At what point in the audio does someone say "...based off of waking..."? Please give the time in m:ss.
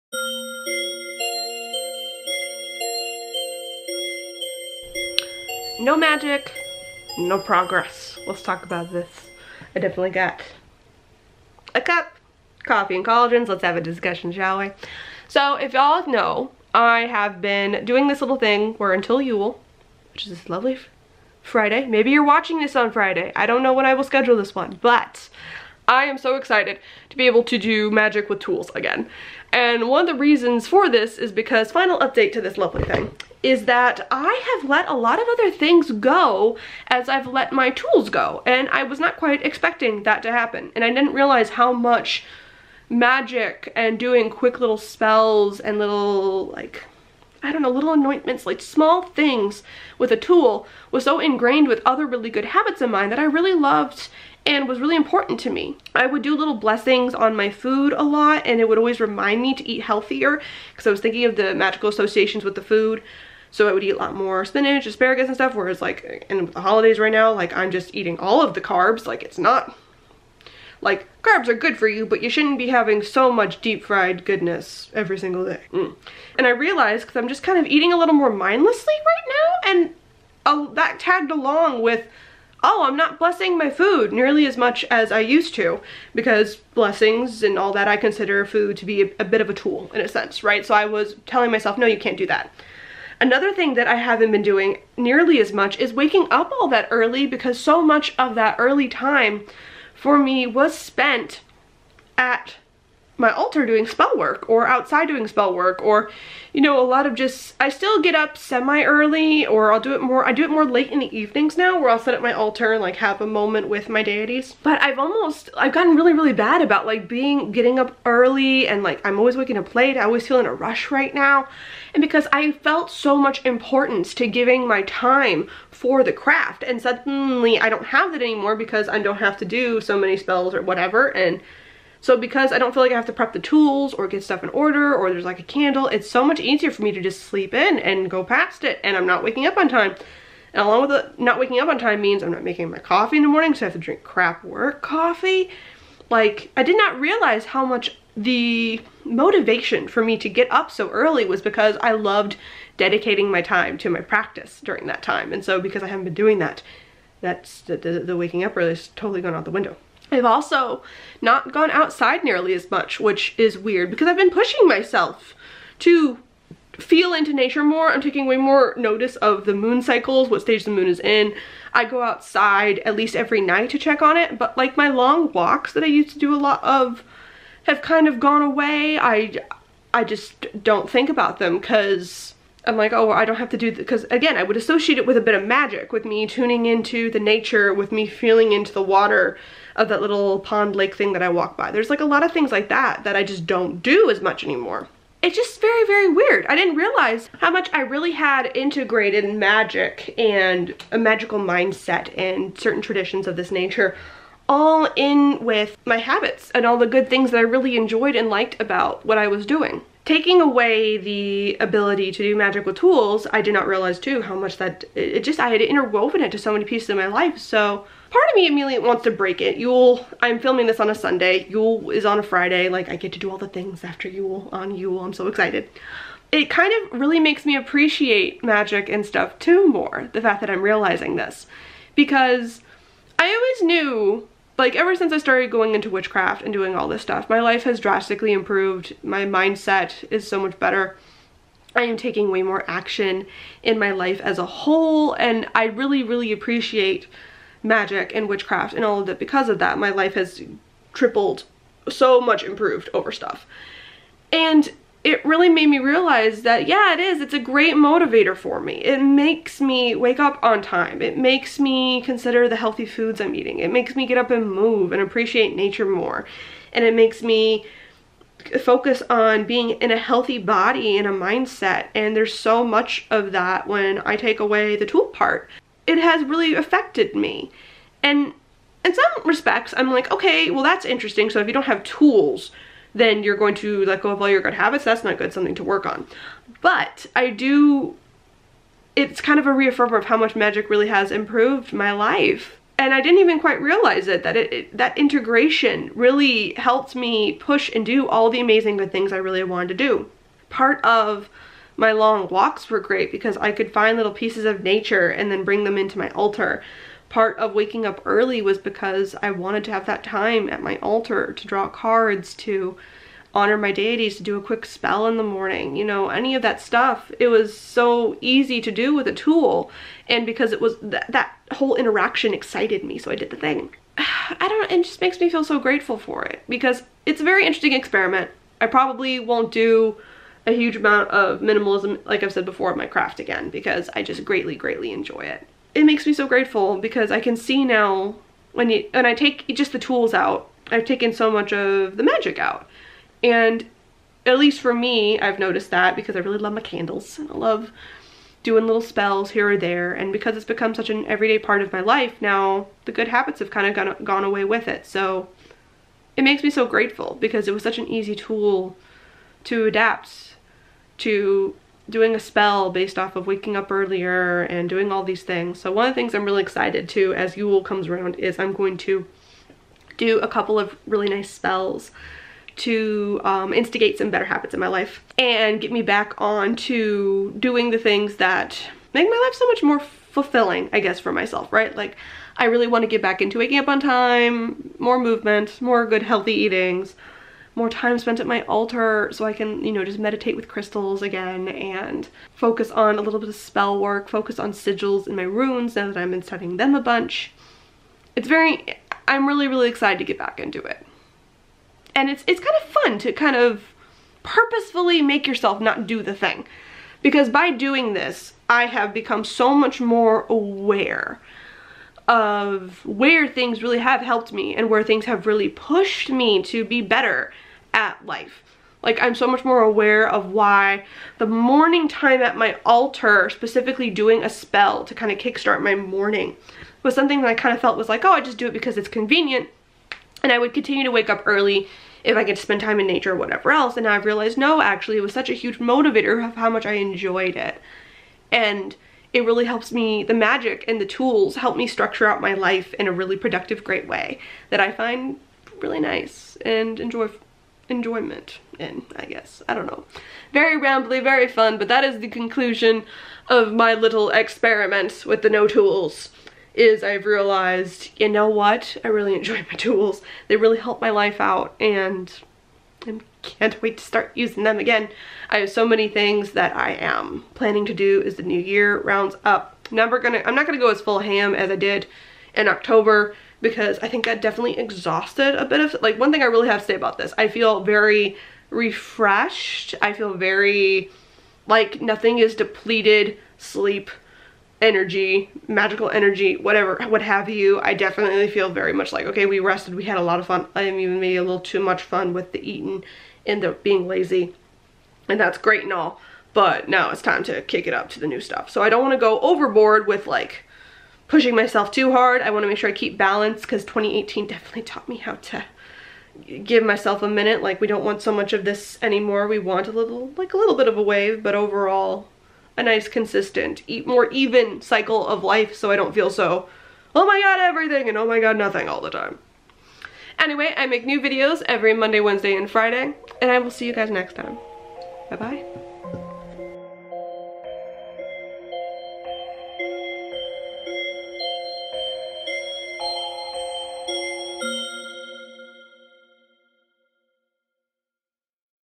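6:02.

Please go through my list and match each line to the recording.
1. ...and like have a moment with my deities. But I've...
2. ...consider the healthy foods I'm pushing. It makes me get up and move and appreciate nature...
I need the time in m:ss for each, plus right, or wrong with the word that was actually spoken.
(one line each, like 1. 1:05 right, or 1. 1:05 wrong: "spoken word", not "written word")
1. 1:52 right
2. 4:22 wrong: "eating", not "pushing".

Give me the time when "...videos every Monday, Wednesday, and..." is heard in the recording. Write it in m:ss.
8:41.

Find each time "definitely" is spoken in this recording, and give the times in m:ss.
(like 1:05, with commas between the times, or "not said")
0:09, 7:54, 8:07, 8:24.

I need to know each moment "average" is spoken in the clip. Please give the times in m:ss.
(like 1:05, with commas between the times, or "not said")
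not said.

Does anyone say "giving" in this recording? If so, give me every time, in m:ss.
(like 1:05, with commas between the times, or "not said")
2:04.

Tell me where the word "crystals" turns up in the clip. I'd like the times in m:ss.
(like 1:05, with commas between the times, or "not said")
6:30.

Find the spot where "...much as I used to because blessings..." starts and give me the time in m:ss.
1:24.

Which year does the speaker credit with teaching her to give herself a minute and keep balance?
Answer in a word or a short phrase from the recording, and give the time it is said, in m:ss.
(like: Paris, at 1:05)
2018, at 8:23.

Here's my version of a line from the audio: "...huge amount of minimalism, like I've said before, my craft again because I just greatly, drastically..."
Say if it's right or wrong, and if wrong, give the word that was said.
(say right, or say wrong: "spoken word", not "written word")
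wrong: "greatly", not "drastically".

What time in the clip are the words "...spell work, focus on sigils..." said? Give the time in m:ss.
6:33.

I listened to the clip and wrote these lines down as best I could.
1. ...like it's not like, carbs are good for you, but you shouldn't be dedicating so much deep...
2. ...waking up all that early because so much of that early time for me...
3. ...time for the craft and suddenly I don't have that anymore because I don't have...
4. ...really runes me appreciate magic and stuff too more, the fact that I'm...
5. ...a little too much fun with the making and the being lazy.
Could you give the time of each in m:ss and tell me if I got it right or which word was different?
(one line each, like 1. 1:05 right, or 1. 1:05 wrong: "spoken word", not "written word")
1. 1:09 wrong: "having", not "dedicating"
2. 1:35 right
3. 2:04 right
4. 3:46 wrong: "makes", not "runes"
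5. 8:11 wrong: "eating", not "making".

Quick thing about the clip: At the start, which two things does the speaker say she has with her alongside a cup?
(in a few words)
coffee and collagens.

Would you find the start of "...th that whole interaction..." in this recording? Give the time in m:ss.
5:20.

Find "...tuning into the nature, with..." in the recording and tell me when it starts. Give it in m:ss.
3:06.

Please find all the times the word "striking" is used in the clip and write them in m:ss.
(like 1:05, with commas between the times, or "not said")
not said.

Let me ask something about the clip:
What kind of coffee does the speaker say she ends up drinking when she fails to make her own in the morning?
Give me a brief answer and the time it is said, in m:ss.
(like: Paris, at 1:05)
crap work coffee, at 2:24.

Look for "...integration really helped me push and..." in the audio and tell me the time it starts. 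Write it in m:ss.
4:54.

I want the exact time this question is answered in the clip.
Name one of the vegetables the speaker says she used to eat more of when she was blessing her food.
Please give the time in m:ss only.
1:04.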